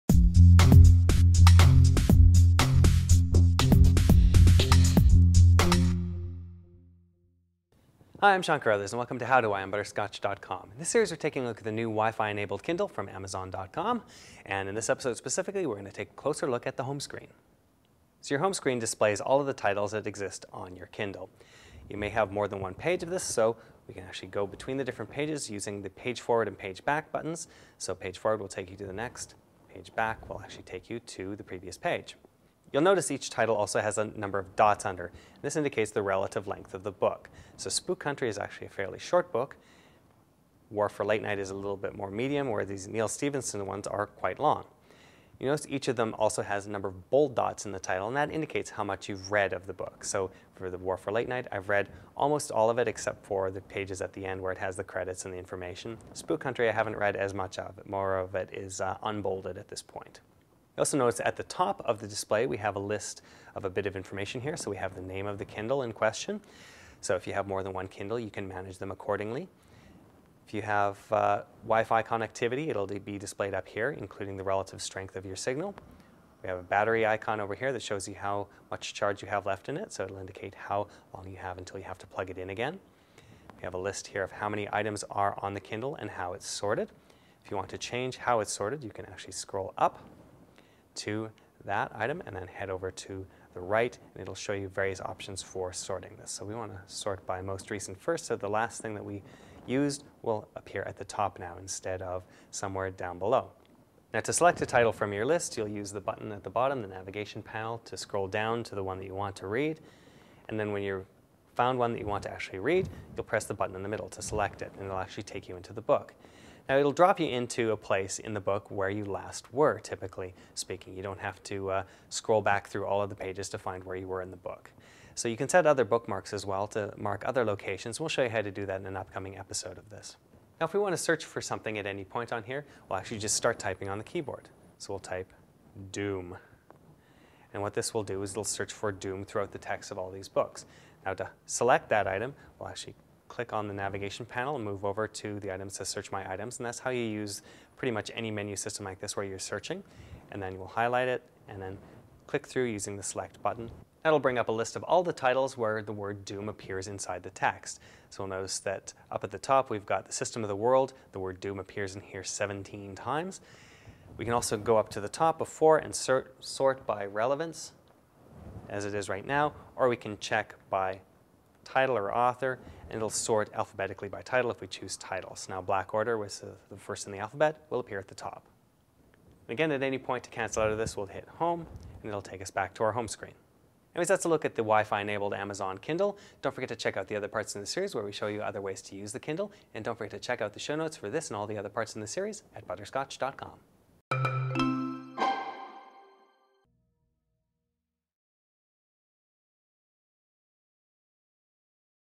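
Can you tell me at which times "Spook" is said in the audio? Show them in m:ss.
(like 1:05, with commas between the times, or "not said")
0:37, 0:56.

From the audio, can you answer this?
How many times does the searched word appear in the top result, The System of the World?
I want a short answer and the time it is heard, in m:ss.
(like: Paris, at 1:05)
17, at 2:42.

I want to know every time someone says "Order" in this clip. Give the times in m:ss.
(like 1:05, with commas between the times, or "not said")
2:55.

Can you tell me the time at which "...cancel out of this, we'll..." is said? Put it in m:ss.
3:00.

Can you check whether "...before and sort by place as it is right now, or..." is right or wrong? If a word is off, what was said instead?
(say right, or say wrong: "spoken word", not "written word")
wrong: "relevance", not "place".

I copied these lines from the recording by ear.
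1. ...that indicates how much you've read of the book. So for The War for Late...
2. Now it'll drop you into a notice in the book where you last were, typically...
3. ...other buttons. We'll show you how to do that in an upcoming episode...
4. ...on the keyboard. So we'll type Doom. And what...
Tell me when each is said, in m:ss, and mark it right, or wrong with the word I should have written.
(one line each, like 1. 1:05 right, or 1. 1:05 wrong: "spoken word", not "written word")
1. 0:48 right
2. 1:56 wrong: "place", not "notice"
3. 2:07 wrong: "locations", not "buttons"
4. 2:13 right.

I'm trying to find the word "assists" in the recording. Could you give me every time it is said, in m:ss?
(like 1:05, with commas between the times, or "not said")
not said.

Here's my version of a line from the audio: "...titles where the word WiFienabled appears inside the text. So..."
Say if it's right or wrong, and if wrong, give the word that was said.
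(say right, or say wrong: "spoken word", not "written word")
wrong: "Doom", not "WiFienabled".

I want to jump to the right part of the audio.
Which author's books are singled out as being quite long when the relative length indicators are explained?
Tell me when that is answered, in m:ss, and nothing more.
0:42.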